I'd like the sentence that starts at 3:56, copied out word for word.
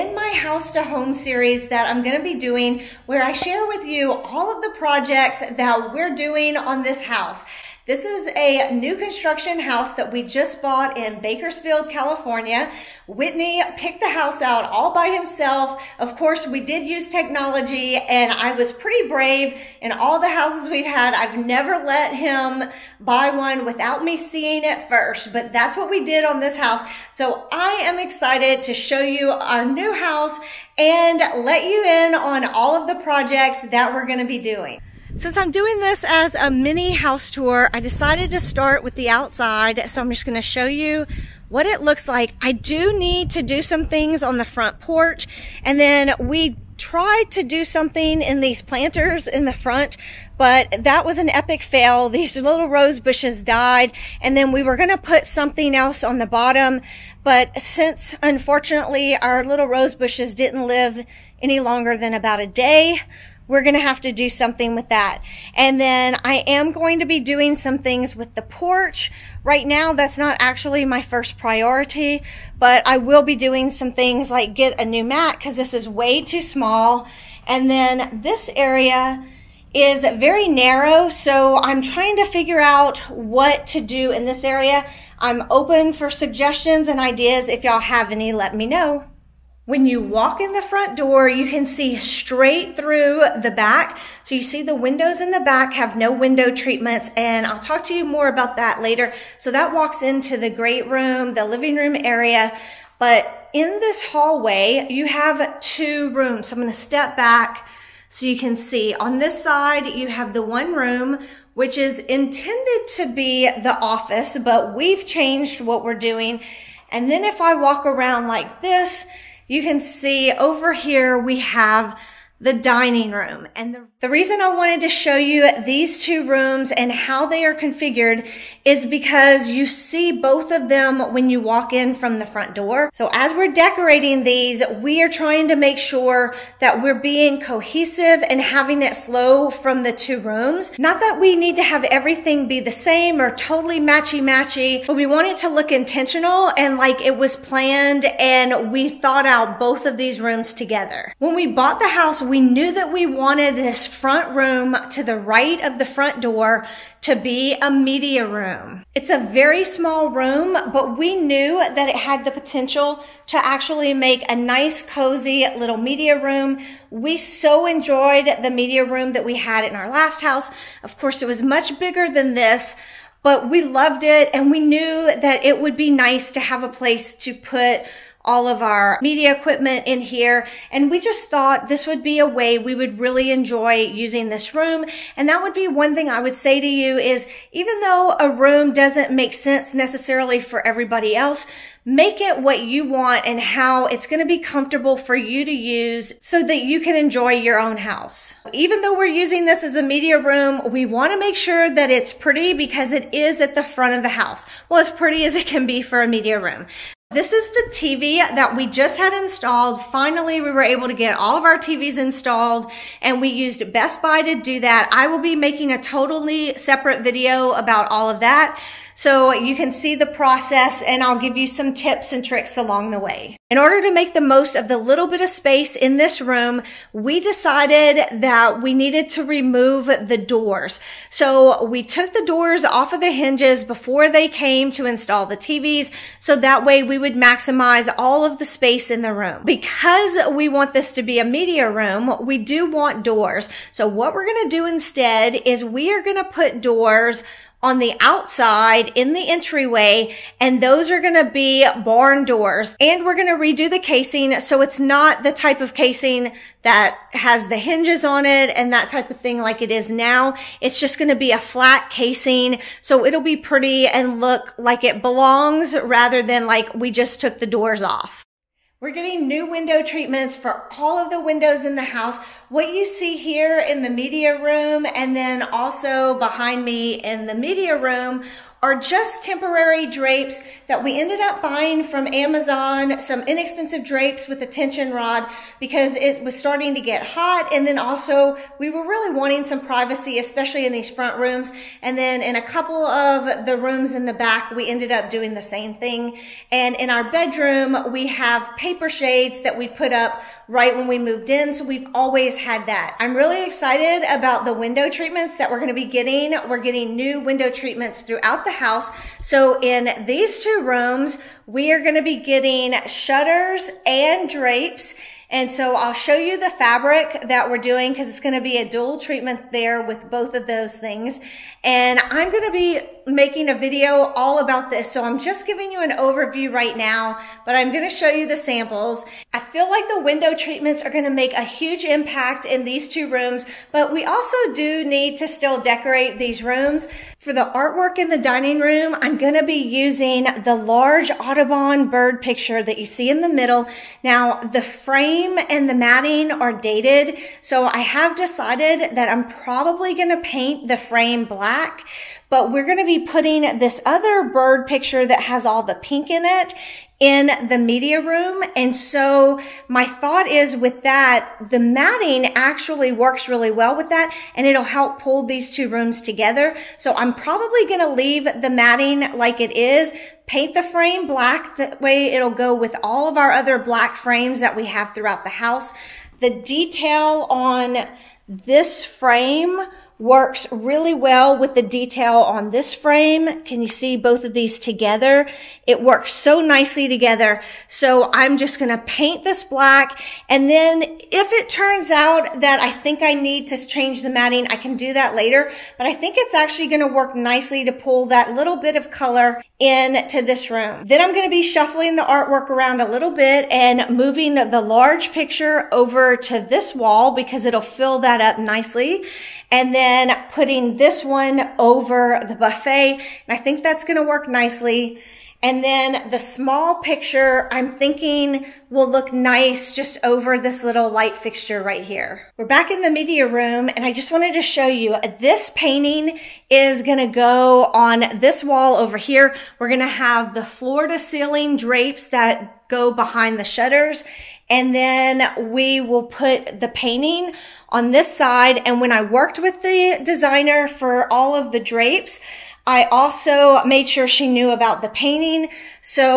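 So that way we would maximize all of the space in the room.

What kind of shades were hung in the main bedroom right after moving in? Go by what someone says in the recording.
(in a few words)
Paper shades.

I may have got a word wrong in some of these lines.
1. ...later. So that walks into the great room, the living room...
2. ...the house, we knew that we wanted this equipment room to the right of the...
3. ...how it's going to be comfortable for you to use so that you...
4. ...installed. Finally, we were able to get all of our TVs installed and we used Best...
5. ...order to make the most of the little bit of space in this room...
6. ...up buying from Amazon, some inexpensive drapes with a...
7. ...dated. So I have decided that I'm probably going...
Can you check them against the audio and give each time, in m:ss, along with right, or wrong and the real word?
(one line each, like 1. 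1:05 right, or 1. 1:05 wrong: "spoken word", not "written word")
1. 1:38 right
2. 2:31 wrong: "front", not "equipment"
3. 3:13 right
4. 3:29 right
5. 3:43 right
6. 4:41 right
7. 5:46 right.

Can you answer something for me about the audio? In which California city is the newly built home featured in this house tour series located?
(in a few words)
Bakersfield.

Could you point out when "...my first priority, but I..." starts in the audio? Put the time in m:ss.
1:10.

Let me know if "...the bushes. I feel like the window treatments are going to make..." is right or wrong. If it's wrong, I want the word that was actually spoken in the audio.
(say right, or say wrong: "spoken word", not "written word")
wrong: "samples", not "bushes".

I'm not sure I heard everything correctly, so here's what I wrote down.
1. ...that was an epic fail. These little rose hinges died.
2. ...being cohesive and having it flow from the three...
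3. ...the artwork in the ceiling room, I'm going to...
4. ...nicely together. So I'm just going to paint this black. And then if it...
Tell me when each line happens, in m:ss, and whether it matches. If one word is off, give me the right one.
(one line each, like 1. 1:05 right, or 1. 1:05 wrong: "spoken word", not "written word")
1. 0:50 wrong: "bushes", not "hinges"
2. 2:16 wrong: "two", not "three"
3. 5:37 wrong: "dining", not "ceiling"
4. 6:26 right.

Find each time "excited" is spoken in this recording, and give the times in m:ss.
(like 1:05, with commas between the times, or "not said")
0:27, 5:03.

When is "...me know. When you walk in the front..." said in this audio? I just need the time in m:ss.
1:28.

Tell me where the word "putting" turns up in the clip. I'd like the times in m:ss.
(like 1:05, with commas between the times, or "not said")
5:53, 6:50.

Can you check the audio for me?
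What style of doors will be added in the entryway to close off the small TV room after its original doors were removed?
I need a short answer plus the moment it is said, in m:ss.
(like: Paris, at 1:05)
Barn doors, at 4:11.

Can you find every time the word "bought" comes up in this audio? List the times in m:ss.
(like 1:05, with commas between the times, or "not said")
0:10, 2:31.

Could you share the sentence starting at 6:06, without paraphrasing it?
So I'm probably going to leave the matting like it is, paint the frame black.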